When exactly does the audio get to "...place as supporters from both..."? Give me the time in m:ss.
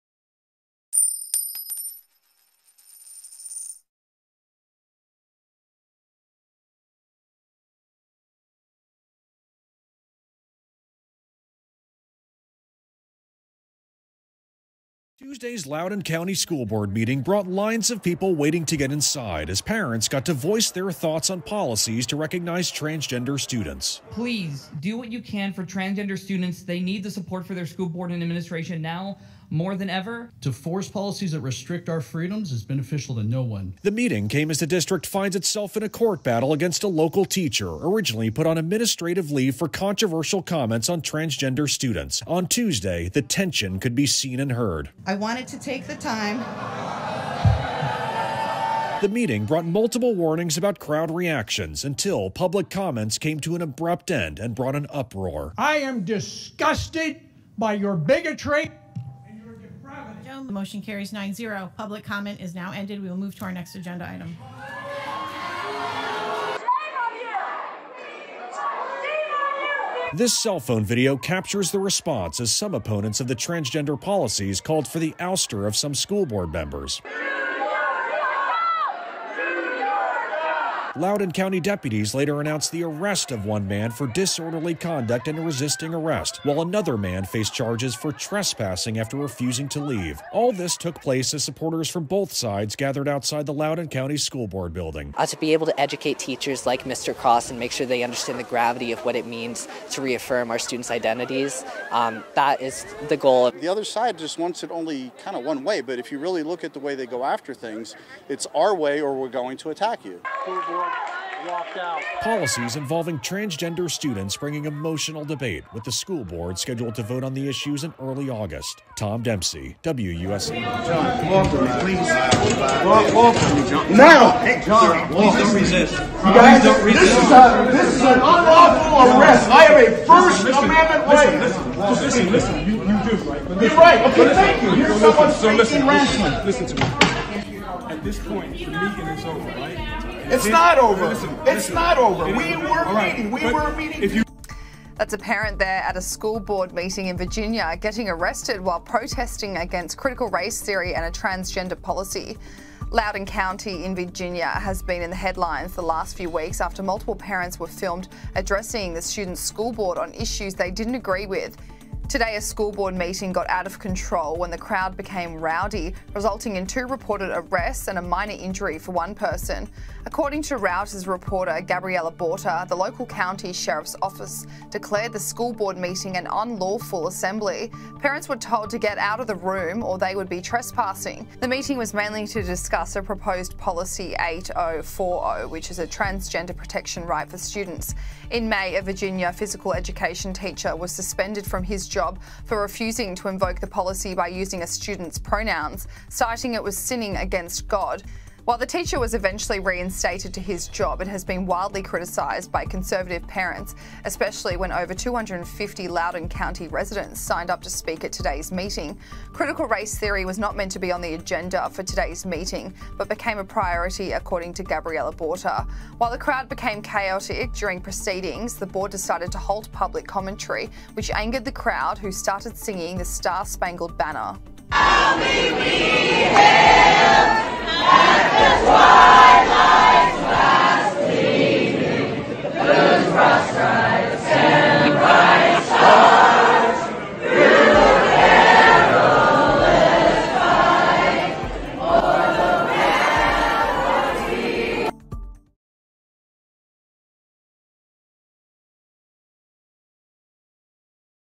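1:31.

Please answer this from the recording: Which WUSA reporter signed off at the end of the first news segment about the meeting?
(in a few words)
Tom Dempsey.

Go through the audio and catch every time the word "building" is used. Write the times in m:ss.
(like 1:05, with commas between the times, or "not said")
1:34.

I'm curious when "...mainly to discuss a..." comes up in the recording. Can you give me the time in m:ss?
3:01.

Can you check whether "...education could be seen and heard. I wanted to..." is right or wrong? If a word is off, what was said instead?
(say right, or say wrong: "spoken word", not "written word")
wrong: "tension", not "education".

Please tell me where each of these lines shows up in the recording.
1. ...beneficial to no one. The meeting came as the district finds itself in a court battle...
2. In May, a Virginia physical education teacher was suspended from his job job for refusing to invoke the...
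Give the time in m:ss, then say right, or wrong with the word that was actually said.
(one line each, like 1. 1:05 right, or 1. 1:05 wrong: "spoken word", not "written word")
1. 0:32 right
2. 3:08 right.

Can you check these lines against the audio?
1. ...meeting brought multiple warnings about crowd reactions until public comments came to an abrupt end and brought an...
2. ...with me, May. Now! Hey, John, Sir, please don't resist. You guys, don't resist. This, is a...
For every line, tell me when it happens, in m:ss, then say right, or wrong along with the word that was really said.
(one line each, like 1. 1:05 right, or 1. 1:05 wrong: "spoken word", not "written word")
1. 0:49 right
2. 2:03 wrong: "John", not "May".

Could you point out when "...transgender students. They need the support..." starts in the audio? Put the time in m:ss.
0:25.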